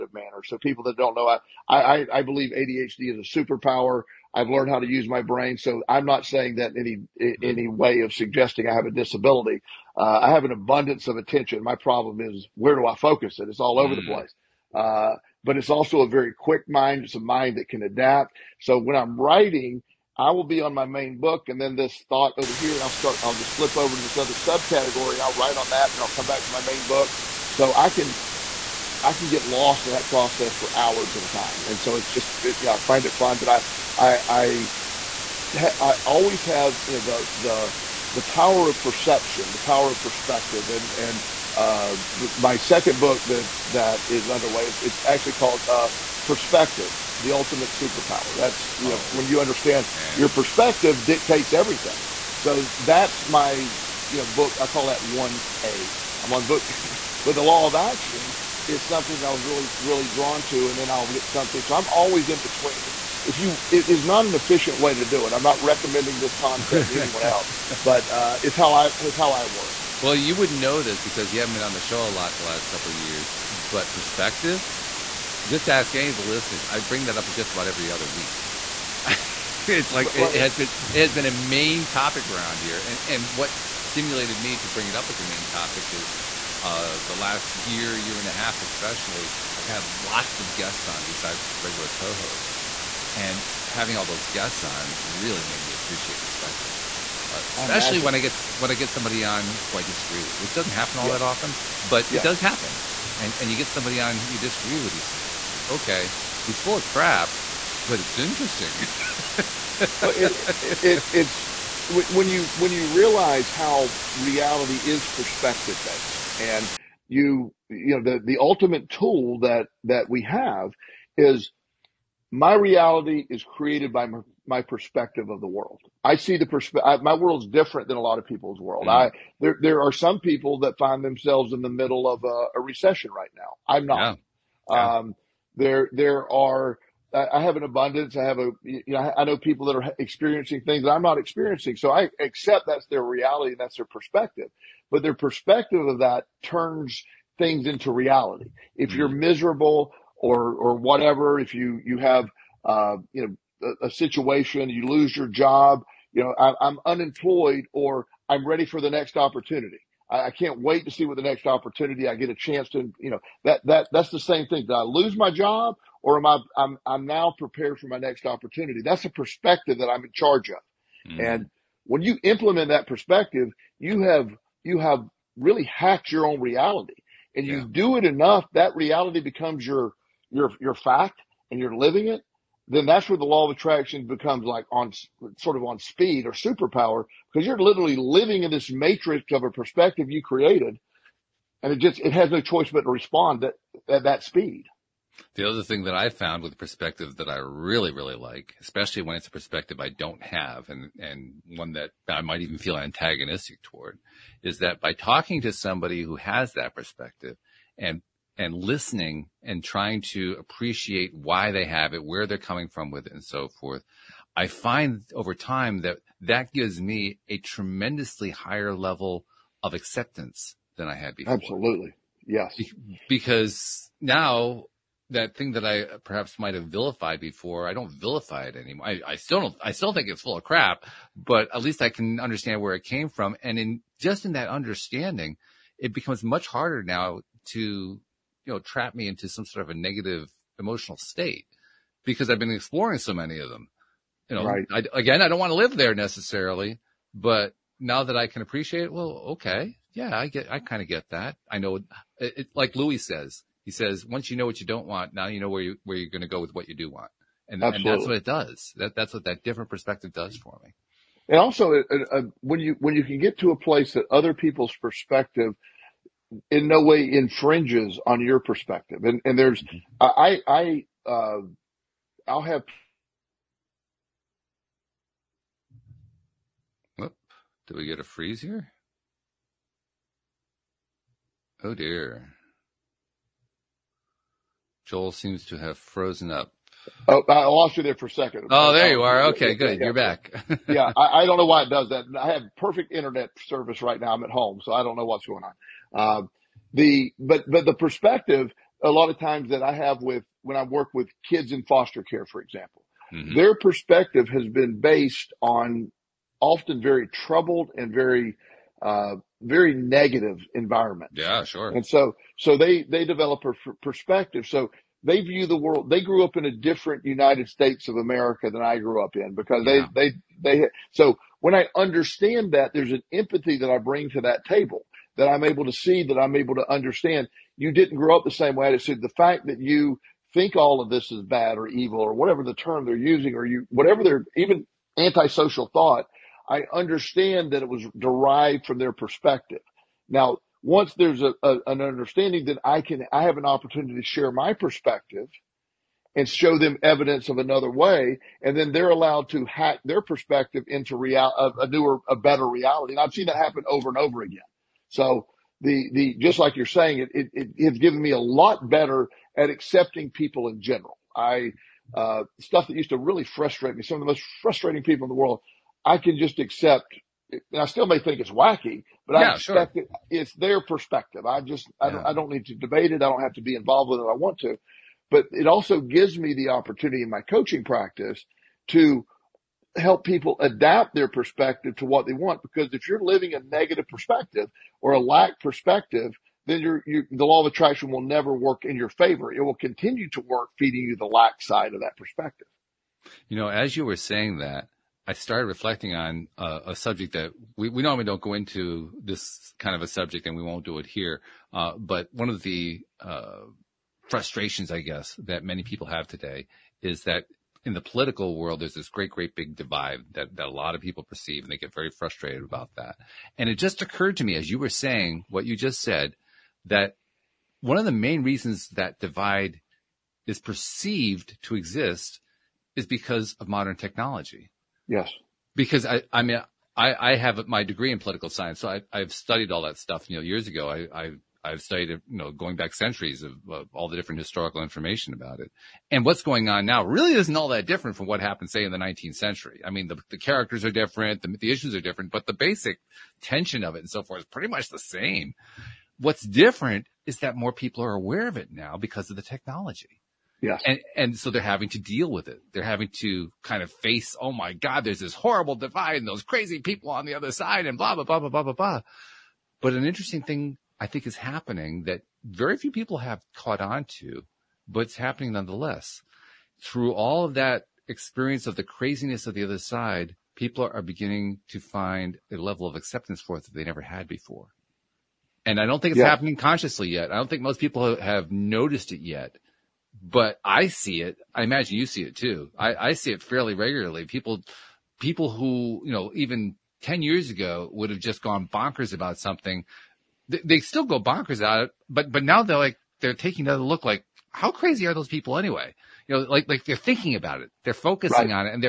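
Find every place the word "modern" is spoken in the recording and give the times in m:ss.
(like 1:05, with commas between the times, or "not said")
7:03.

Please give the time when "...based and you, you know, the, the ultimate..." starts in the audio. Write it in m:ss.
1:55.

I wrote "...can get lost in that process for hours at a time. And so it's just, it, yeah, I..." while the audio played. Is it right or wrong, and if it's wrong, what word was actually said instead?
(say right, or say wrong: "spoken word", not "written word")
right.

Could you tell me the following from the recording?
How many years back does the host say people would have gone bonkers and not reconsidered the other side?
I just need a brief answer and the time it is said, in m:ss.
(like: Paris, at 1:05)
10, at 8:06.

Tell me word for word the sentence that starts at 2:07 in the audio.
My world's different than a lot of people's world.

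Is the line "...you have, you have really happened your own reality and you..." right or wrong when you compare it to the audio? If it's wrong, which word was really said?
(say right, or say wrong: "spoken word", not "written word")
wrong: "hacked", not "happened".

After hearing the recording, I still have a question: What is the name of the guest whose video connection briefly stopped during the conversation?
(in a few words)
Joel.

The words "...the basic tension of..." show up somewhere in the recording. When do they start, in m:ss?
7:22.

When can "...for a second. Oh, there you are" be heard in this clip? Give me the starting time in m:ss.
4:47.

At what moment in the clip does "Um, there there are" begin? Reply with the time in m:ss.
2:14.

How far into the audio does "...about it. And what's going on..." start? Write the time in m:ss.
7:15.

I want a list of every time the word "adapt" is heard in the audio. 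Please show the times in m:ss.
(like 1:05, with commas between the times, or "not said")
0:17, 6:20.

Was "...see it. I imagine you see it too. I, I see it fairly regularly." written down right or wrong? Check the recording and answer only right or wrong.
right.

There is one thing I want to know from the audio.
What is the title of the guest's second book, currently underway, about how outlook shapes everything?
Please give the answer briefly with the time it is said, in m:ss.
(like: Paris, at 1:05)
Perspective: The Ultimate Superpower, at 0:46.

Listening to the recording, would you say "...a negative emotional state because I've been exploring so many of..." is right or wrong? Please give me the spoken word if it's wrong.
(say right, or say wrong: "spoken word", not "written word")
right.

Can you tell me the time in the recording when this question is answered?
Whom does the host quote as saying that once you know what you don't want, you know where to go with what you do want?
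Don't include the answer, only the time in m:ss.
4:12.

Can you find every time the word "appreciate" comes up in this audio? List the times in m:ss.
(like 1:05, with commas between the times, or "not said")
1:35, 3:30, 4:08.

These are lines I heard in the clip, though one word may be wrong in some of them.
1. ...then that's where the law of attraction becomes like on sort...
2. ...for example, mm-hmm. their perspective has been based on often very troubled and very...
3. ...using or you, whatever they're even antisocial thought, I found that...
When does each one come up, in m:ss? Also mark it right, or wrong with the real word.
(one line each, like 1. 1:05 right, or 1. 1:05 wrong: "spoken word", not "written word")
1. 3:02 right
2. 5:02 right
3. 5:32 wrong: "understand", not "found".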